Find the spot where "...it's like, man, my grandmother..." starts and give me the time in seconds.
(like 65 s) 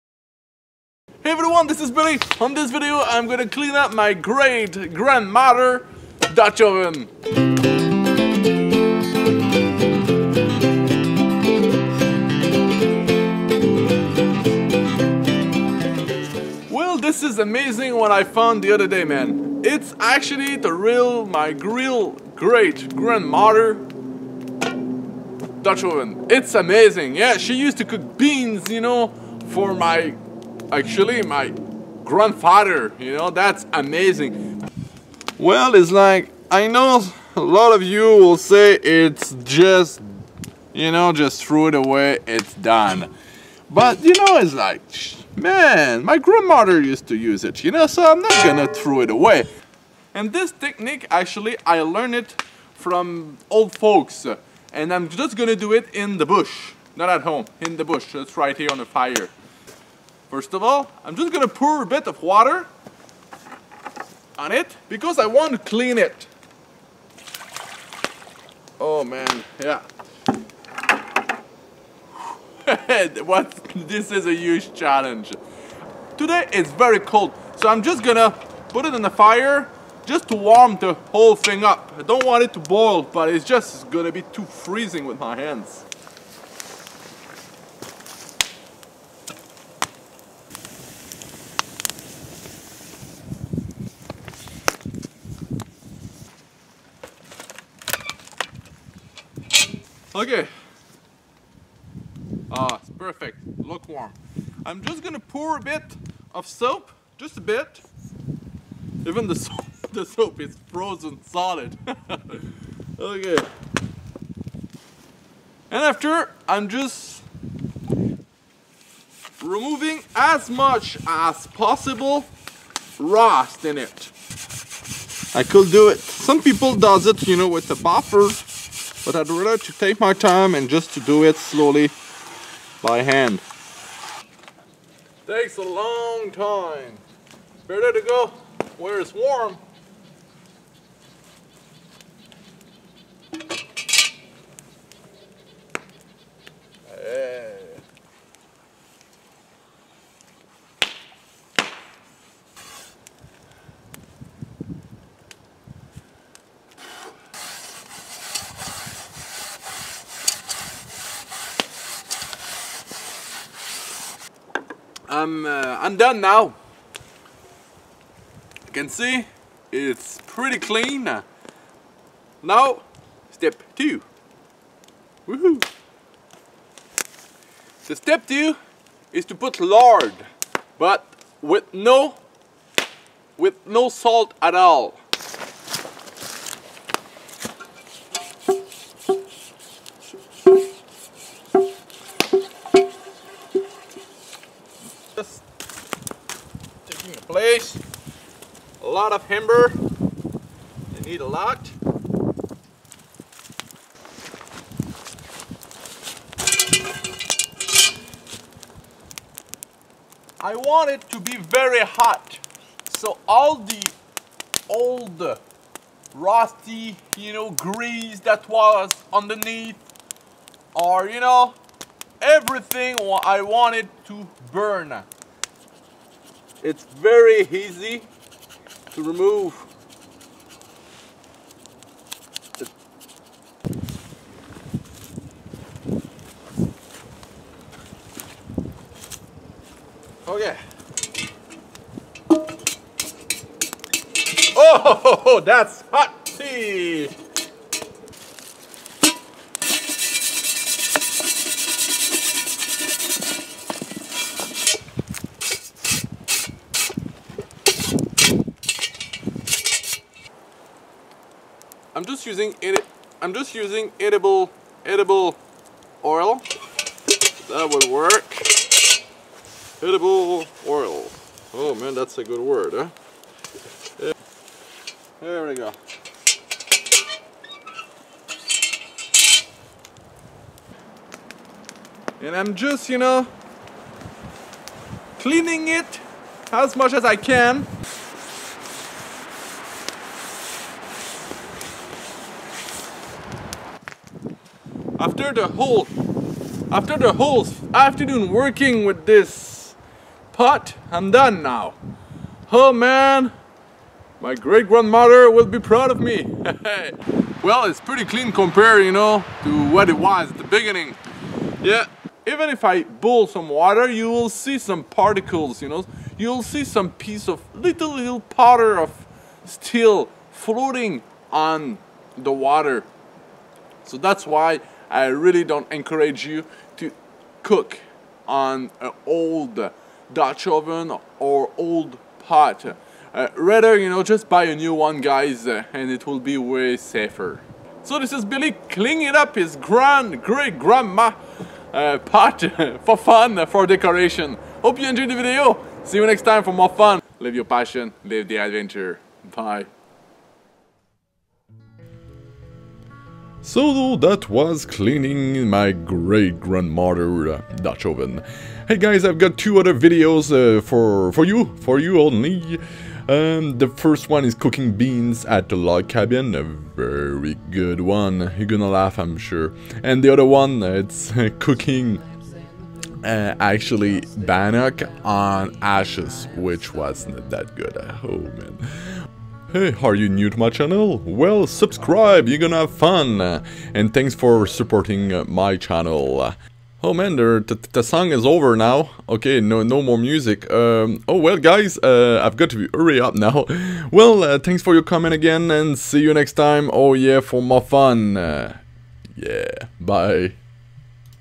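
44 s.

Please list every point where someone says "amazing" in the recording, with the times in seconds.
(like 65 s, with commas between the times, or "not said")
17 s, 26 s, 33 s.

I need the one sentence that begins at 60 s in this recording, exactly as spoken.
First of all, I'm just gonna pour a bit of water on it because I want to clean it.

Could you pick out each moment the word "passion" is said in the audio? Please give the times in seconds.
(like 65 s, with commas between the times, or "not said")
347 s.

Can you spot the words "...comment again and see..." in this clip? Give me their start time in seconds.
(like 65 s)
394 s.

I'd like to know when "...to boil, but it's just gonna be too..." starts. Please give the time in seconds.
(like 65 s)
82 s.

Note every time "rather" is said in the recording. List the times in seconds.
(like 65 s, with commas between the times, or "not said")
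129 s, 333 s.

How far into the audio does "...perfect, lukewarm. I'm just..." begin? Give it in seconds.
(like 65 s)
102 s.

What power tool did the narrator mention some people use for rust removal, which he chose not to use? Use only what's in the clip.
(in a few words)
A buffer.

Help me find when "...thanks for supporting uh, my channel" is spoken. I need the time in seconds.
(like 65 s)
383 s.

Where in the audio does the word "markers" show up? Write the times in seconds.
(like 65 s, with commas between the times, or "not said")
not said.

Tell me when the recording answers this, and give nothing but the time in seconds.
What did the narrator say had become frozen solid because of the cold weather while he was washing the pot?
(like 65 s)
109 s.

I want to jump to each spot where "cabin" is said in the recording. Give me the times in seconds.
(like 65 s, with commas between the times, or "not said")
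365 s.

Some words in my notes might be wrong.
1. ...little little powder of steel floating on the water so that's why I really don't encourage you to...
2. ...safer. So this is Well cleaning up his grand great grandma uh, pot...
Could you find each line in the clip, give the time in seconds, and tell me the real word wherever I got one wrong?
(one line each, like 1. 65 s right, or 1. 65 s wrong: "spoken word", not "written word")
1. 317 s right
2. 336 s wrong: "Billy", not "Well".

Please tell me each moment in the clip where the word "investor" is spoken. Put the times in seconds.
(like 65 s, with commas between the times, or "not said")
not said.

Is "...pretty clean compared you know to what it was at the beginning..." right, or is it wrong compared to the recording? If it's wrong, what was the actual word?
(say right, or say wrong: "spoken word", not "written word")
right.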